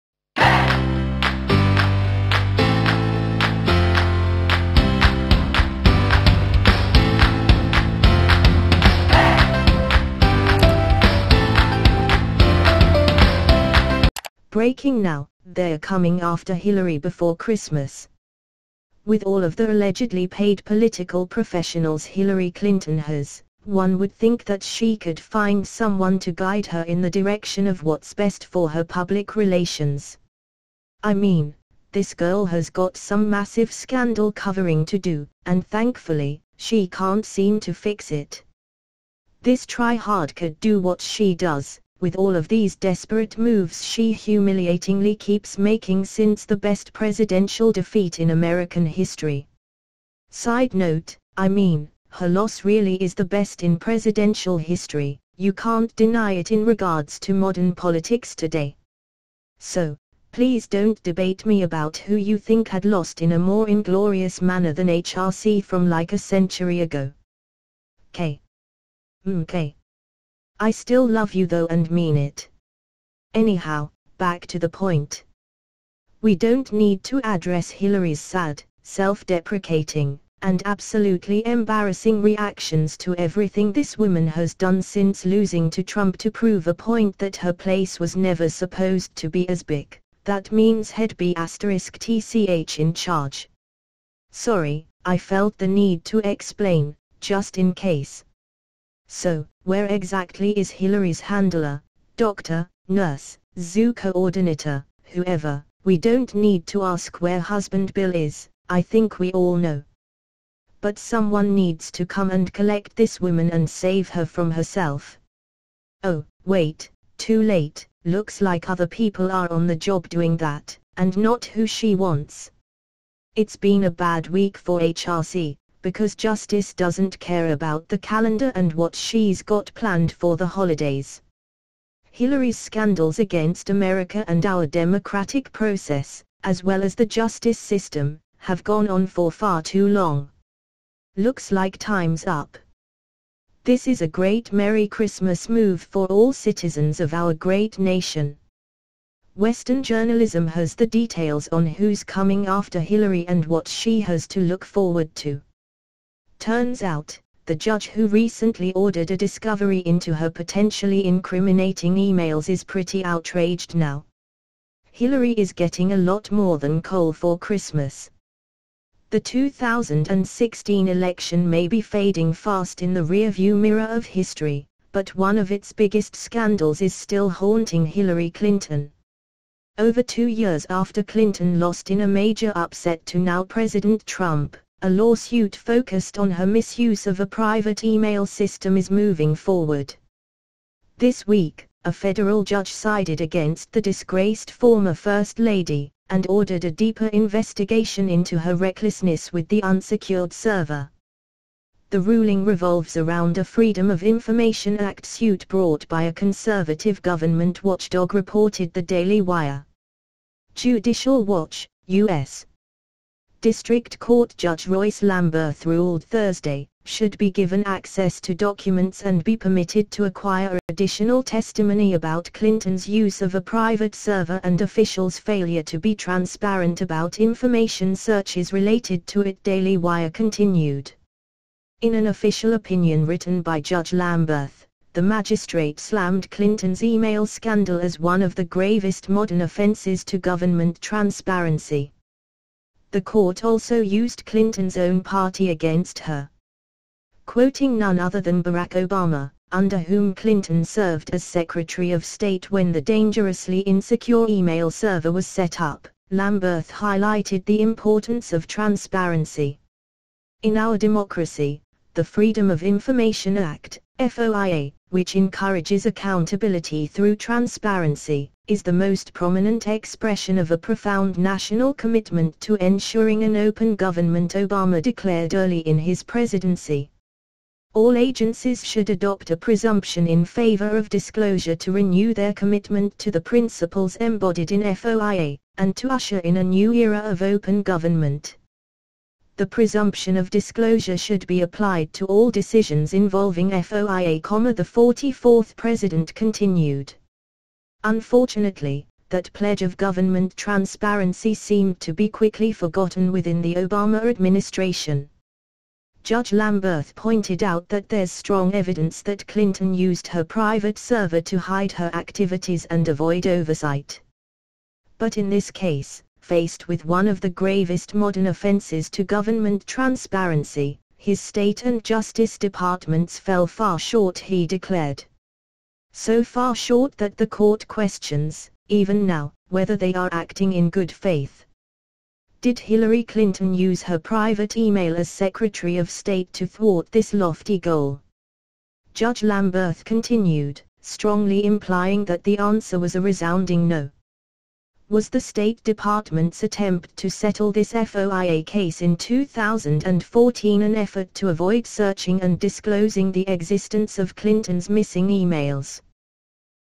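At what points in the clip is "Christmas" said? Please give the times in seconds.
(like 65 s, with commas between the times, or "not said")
17 s, 144 s, 167 s.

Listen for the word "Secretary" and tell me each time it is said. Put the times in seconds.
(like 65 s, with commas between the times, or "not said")
251 s, 335 s.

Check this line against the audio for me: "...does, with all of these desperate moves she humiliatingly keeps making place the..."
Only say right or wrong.
wrong.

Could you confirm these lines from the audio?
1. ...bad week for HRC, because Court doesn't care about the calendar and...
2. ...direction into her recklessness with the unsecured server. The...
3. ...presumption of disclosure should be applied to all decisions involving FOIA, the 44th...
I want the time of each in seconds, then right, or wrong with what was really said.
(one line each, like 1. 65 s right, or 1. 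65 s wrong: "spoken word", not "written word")
1. 123 s wrong: "Justice", not "Court"
2. 197 s wrong: "investigation", not "direction"
3. 289 s right.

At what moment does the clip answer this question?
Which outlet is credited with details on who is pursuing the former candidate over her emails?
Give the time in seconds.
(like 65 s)
149 s.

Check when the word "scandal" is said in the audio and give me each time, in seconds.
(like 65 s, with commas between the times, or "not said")
33 s, 132 s, 176 s, 237 s.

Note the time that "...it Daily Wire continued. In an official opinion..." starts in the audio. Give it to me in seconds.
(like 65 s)
229 s.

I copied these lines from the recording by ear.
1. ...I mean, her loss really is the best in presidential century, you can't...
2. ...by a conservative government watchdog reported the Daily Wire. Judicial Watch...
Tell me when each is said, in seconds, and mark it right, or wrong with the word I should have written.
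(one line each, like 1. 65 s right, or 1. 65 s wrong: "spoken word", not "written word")
1. 51 s wrong: "history", not "century"
2. 205 s right.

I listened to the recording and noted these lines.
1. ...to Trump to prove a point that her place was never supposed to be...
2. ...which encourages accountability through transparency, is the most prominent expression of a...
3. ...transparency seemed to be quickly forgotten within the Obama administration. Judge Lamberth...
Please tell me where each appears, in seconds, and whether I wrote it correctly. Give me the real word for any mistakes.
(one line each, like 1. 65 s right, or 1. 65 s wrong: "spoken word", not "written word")
1. 85 s right
2. 264 s right
3. 300 s right.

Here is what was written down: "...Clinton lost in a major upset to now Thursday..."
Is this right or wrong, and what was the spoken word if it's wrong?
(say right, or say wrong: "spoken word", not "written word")
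wrong: "President", not "Thursday".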